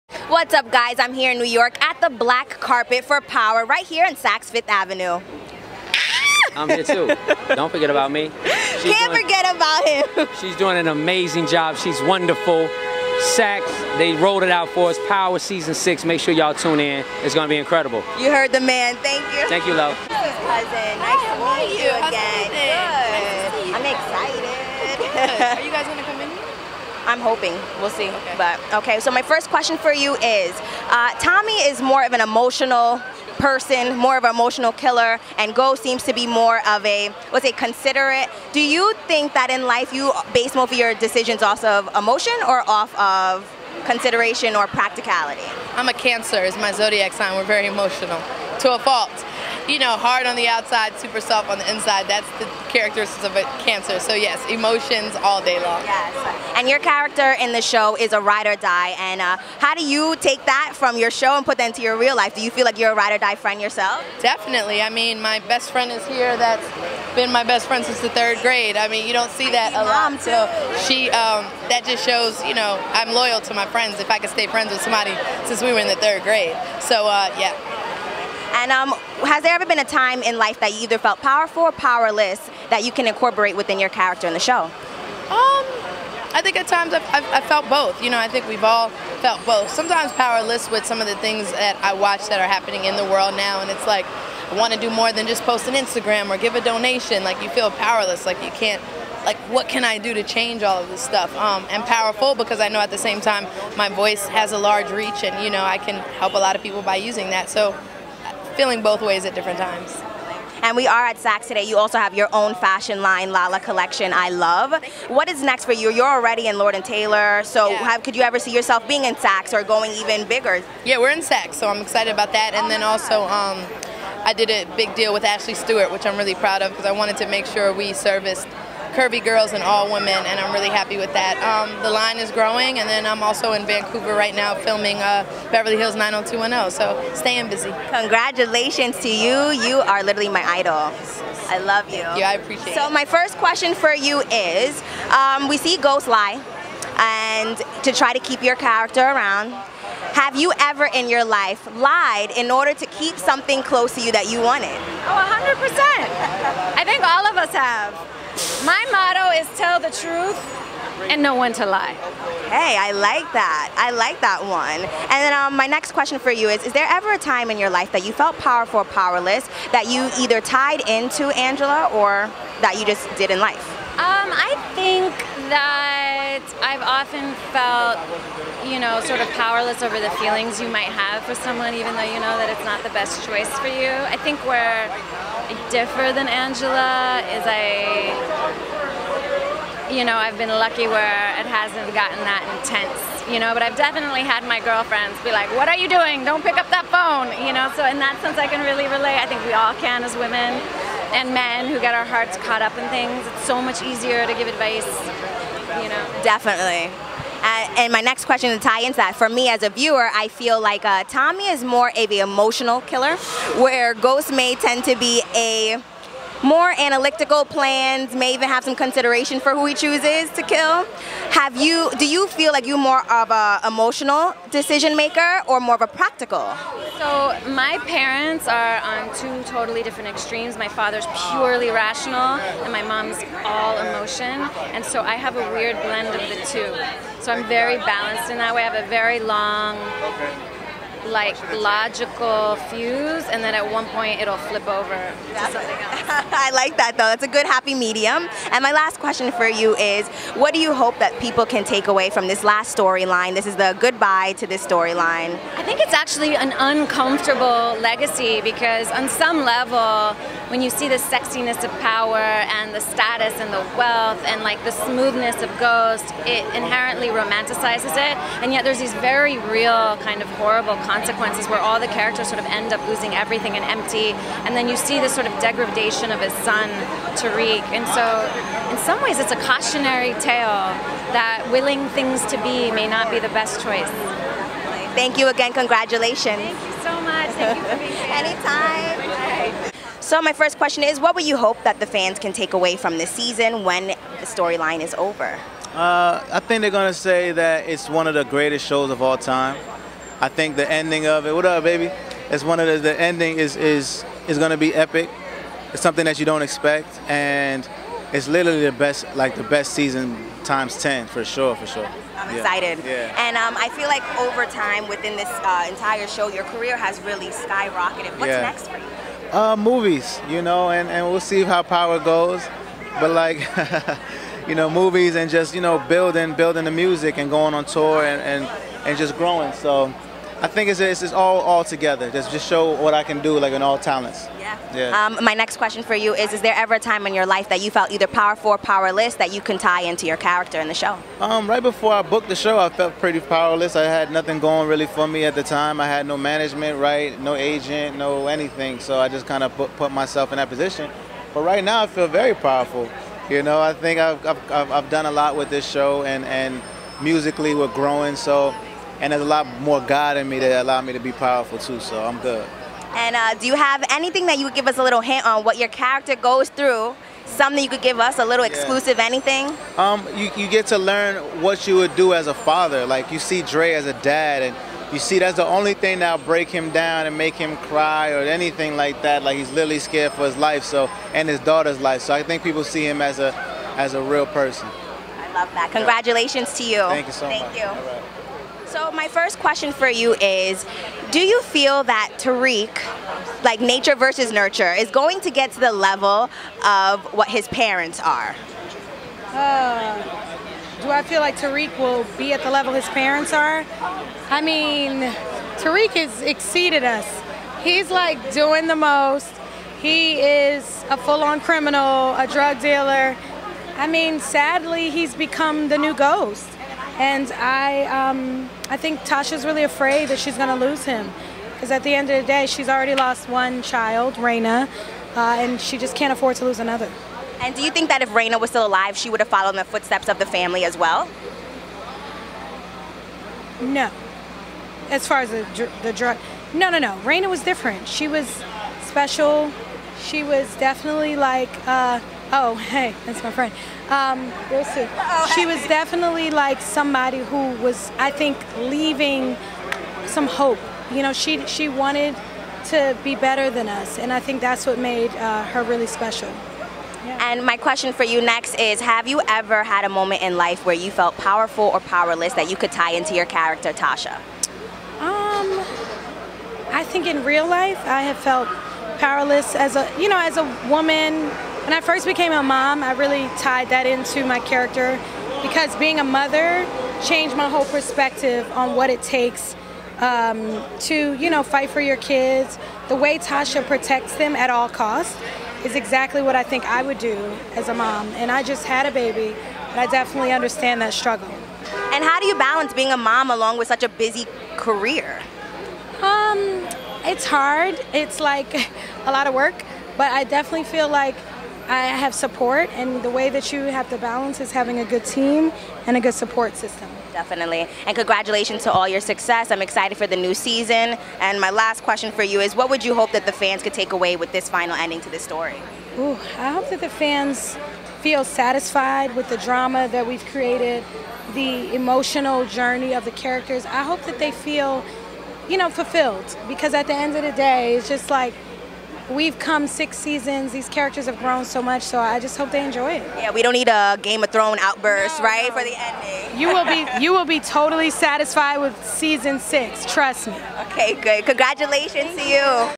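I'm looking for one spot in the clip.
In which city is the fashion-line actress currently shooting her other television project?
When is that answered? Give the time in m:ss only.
2:13.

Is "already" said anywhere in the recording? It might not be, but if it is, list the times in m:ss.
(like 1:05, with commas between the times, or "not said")
1:56, 7:02.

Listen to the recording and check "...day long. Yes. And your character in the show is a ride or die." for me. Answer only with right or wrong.
right.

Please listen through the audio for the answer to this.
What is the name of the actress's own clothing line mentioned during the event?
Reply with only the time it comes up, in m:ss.
1:53.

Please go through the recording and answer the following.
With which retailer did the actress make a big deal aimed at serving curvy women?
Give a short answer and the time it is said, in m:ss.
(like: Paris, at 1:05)
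Ashley Stewart, at 2:05.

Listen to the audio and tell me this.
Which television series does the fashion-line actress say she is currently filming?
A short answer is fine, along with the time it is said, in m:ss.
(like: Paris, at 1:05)
Beverly Hills 90210, at 2:15.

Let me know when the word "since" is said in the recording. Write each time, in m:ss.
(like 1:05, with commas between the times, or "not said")
1:07, 1:15.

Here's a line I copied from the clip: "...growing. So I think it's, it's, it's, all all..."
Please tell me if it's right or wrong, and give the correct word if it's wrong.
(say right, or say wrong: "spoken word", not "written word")
right.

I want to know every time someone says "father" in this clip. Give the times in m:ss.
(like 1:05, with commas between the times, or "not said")
3:50, 6:12.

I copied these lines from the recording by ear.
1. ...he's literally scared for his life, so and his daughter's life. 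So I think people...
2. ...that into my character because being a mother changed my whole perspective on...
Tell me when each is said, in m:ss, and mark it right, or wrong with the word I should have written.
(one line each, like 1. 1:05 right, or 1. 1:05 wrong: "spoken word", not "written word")
1. 6:19 right
2. 7:53 right.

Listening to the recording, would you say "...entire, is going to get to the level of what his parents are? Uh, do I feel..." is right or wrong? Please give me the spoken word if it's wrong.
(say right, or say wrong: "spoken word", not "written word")
wrong: "nurture", not "entire".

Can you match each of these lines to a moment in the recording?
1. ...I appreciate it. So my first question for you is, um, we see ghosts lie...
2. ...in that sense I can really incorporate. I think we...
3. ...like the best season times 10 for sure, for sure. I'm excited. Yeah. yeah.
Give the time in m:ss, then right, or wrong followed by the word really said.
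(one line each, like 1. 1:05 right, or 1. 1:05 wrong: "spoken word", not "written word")
1. 2:22 right
2. 3:17 wrong: "relate", not "incorporate"
3. 5:09 right.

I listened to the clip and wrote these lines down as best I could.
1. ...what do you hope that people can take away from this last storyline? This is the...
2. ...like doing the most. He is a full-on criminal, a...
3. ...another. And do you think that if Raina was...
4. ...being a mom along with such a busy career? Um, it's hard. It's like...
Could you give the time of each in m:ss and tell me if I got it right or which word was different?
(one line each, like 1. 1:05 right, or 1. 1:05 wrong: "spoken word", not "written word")
1. 4:10 right
2. 6:47 right
3. 7:06 right
4. 8:12 right.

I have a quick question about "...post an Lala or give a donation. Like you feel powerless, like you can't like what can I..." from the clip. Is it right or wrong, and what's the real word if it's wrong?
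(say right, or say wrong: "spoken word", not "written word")
wrong: "Instagram", not "Lala".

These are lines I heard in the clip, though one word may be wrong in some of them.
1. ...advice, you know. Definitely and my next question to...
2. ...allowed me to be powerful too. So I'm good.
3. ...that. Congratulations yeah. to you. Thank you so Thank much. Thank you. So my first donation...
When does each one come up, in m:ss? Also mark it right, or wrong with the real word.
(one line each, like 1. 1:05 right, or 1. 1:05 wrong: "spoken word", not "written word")
1. 3:24 right
2. 6:00 right
3. 6:25 wrong: "question", not "donation".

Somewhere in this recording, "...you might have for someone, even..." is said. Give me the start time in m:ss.
3:00.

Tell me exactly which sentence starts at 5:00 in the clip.
I think the ending of it, what up, baby?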